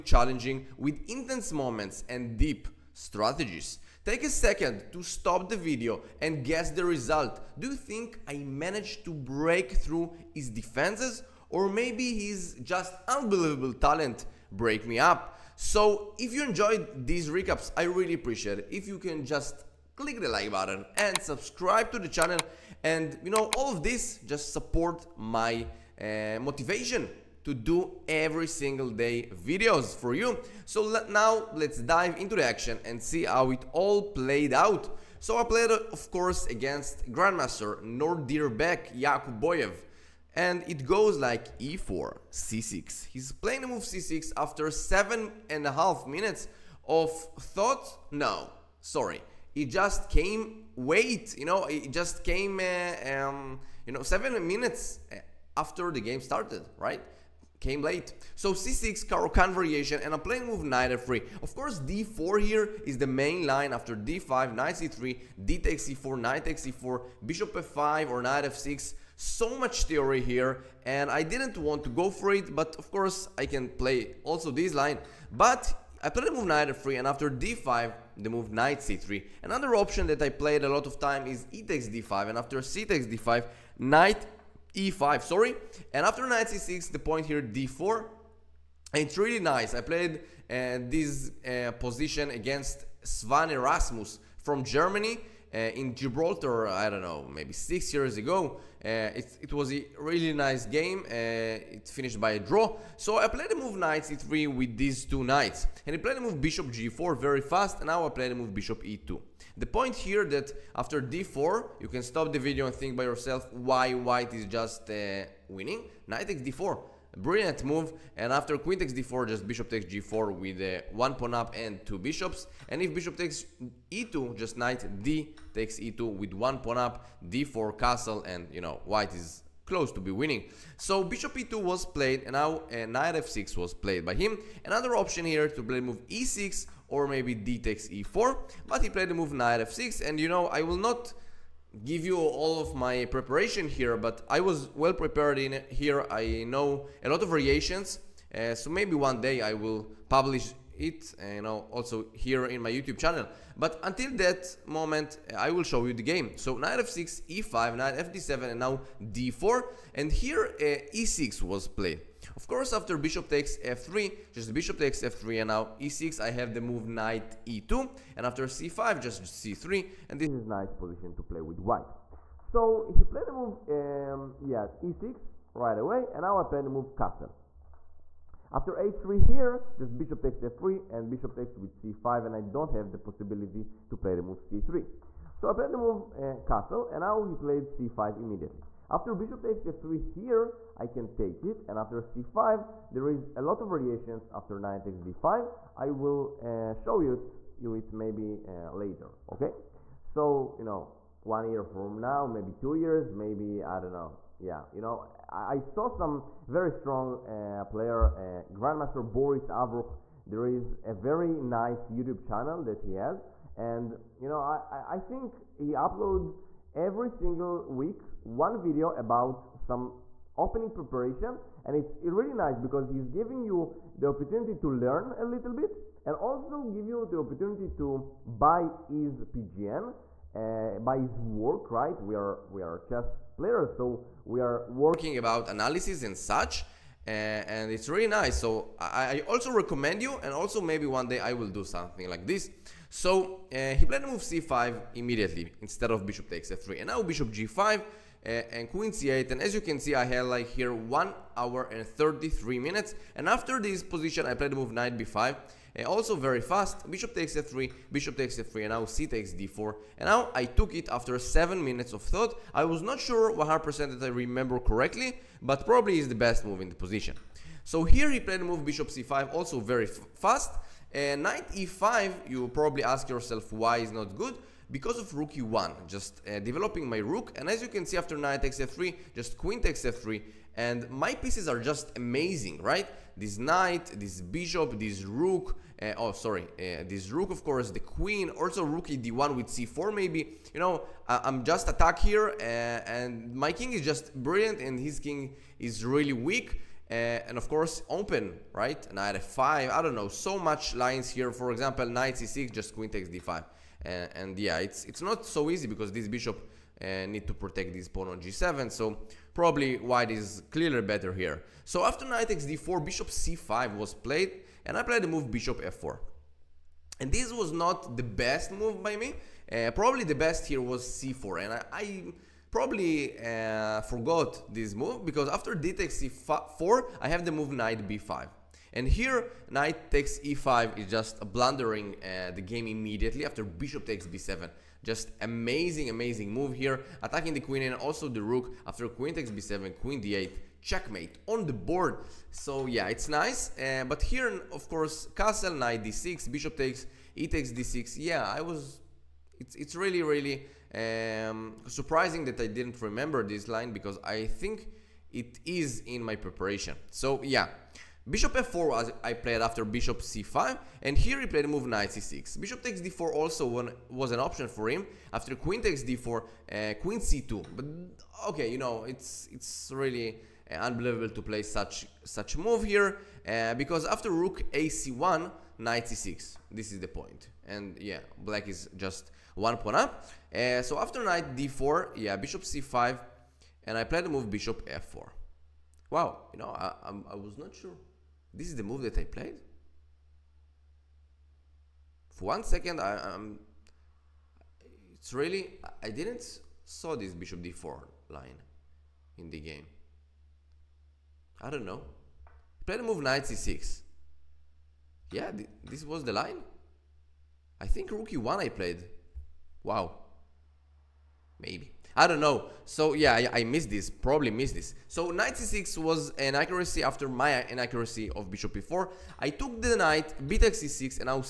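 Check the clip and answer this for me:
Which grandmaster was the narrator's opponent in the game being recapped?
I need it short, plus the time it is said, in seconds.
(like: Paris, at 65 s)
Nodirbek Yakubboev, at 37 s.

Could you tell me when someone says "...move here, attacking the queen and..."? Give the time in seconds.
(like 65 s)
336 s.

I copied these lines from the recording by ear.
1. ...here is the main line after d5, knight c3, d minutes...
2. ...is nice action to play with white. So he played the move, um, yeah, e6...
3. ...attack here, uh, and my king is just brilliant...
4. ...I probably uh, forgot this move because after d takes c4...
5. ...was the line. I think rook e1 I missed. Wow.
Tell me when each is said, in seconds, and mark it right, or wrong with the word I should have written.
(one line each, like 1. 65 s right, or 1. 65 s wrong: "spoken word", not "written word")
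1. 62 s wrong: "takes", not "minutes"
2. 170 s wrong: "position", not "action"
3. 291 s right
4. 321 s right
5. 405 s wrong: "played", not "missed".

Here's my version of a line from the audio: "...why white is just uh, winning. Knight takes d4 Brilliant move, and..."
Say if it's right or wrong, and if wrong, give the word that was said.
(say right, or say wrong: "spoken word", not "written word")
right.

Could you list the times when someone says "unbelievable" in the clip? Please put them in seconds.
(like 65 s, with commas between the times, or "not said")
13 s, 370 s.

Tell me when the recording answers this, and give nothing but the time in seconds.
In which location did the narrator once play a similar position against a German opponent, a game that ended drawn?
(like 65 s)
95 s.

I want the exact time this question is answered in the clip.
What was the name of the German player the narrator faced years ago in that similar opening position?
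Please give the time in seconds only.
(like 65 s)
93 s.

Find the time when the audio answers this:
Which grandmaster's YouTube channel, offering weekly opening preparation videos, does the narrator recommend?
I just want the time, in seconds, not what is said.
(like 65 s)
209 s.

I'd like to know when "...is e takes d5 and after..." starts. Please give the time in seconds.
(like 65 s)
81 s.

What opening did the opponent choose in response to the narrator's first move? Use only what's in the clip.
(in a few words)
Caro-Kann.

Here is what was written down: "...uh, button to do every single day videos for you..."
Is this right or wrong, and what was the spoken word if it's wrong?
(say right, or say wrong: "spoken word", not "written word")
wrong: "motivation", not "button".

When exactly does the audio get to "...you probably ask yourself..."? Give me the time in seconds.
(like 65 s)
272 s.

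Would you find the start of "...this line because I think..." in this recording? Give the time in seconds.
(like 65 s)
353 s.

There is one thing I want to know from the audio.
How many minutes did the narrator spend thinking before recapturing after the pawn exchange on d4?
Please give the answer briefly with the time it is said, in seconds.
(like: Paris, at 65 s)
7, at 261 s.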